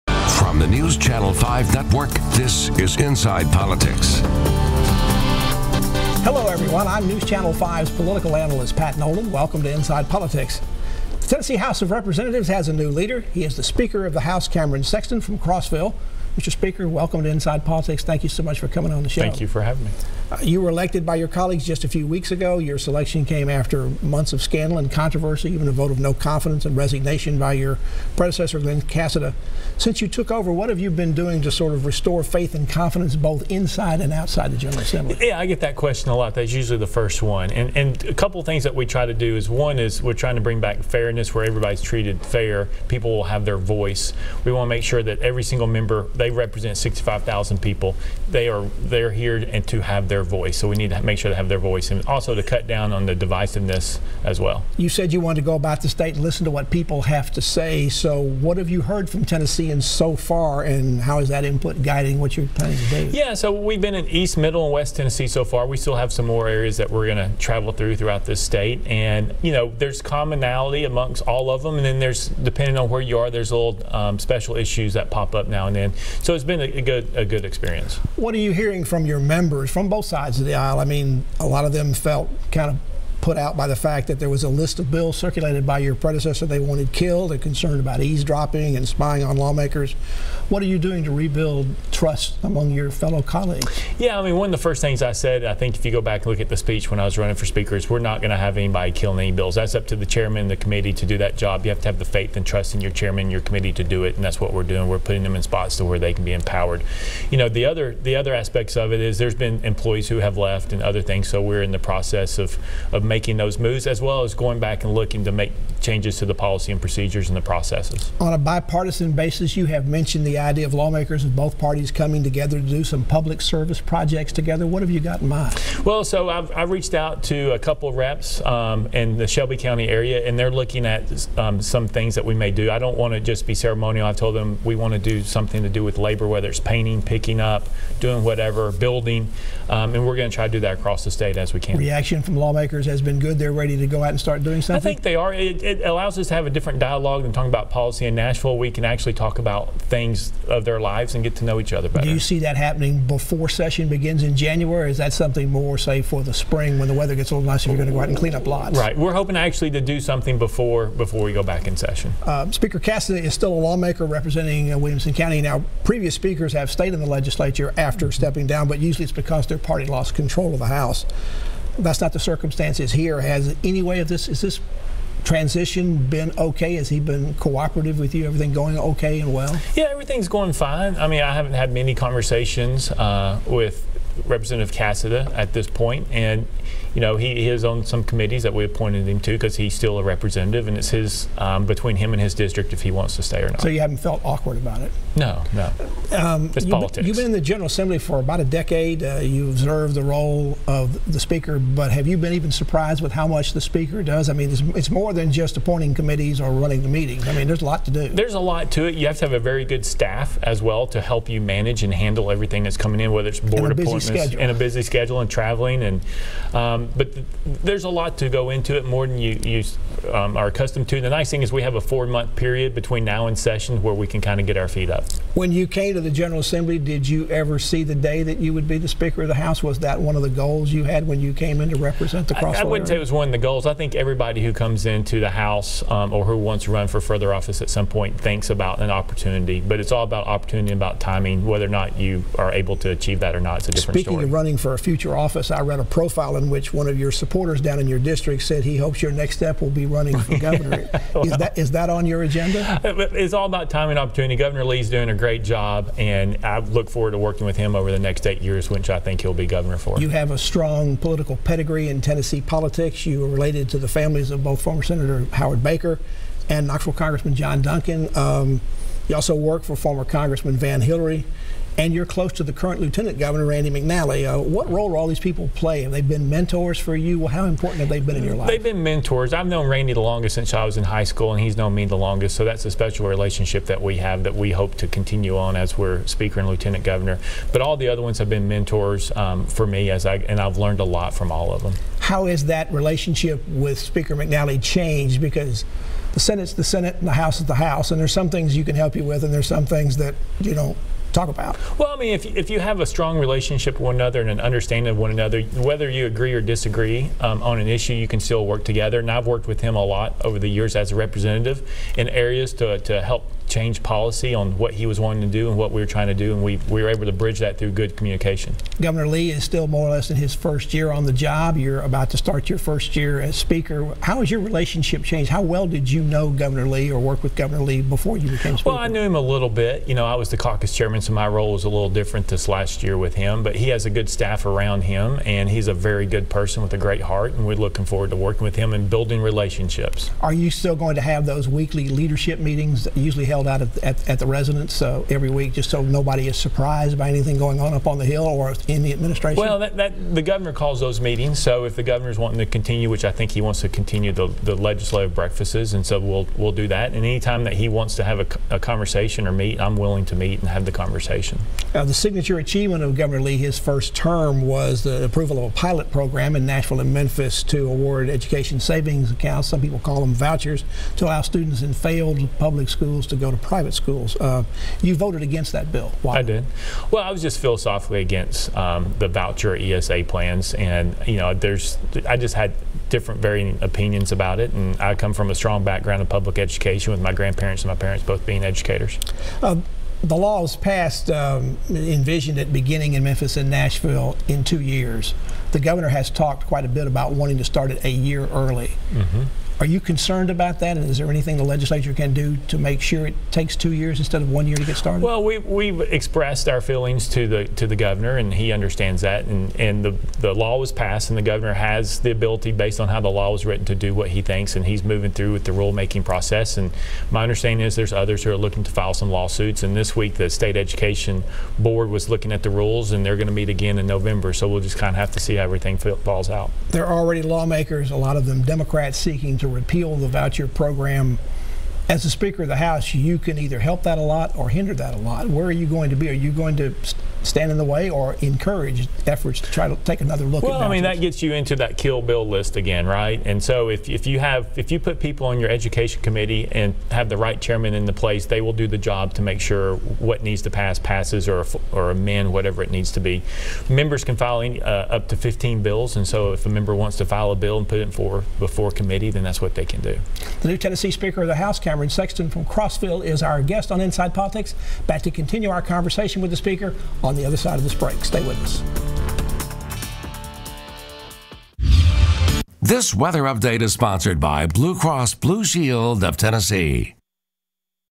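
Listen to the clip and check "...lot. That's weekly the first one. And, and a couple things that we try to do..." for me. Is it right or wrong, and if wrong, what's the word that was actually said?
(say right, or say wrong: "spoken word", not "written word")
wrong: "usually", not "weekly".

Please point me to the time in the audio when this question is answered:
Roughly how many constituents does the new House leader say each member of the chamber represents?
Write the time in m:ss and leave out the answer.
0:46.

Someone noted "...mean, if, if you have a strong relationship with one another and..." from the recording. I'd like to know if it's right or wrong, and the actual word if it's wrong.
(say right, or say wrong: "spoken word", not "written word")
right.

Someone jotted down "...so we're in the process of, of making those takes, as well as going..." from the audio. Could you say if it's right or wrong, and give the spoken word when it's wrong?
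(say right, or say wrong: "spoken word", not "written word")
wrong: "moves", not "takes".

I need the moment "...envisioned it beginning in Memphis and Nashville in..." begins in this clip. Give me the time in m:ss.
6:31.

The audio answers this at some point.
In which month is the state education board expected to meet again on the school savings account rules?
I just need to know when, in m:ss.
7:03.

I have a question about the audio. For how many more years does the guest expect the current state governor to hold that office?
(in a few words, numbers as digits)
8.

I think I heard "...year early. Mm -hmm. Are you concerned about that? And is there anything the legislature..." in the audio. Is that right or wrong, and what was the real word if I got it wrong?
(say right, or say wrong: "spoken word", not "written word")
right.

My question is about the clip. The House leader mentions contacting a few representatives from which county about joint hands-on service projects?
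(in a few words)
Shelby County.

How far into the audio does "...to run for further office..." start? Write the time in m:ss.
3:56.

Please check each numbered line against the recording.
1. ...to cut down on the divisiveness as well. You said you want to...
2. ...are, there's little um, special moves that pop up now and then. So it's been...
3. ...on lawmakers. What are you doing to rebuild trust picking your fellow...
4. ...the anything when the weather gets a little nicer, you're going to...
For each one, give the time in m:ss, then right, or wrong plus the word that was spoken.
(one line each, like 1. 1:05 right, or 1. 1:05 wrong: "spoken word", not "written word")
1. 0:52 right
2. 1:13 wrong: "issues", not "moves"
3. 1:29 wrong: "among", not "picking"
4. 2:36 wrong: "spring", not "anything".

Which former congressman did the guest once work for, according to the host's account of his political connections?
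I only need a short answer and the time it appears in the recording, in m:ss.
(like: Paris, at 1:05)
Van Hilleary, at 4:30.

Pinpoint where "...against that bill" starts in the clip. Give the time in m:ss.
6:15.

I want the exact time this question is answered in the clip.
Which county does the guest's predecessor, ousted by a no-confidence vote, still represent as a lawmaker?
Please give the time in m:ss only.
2:44.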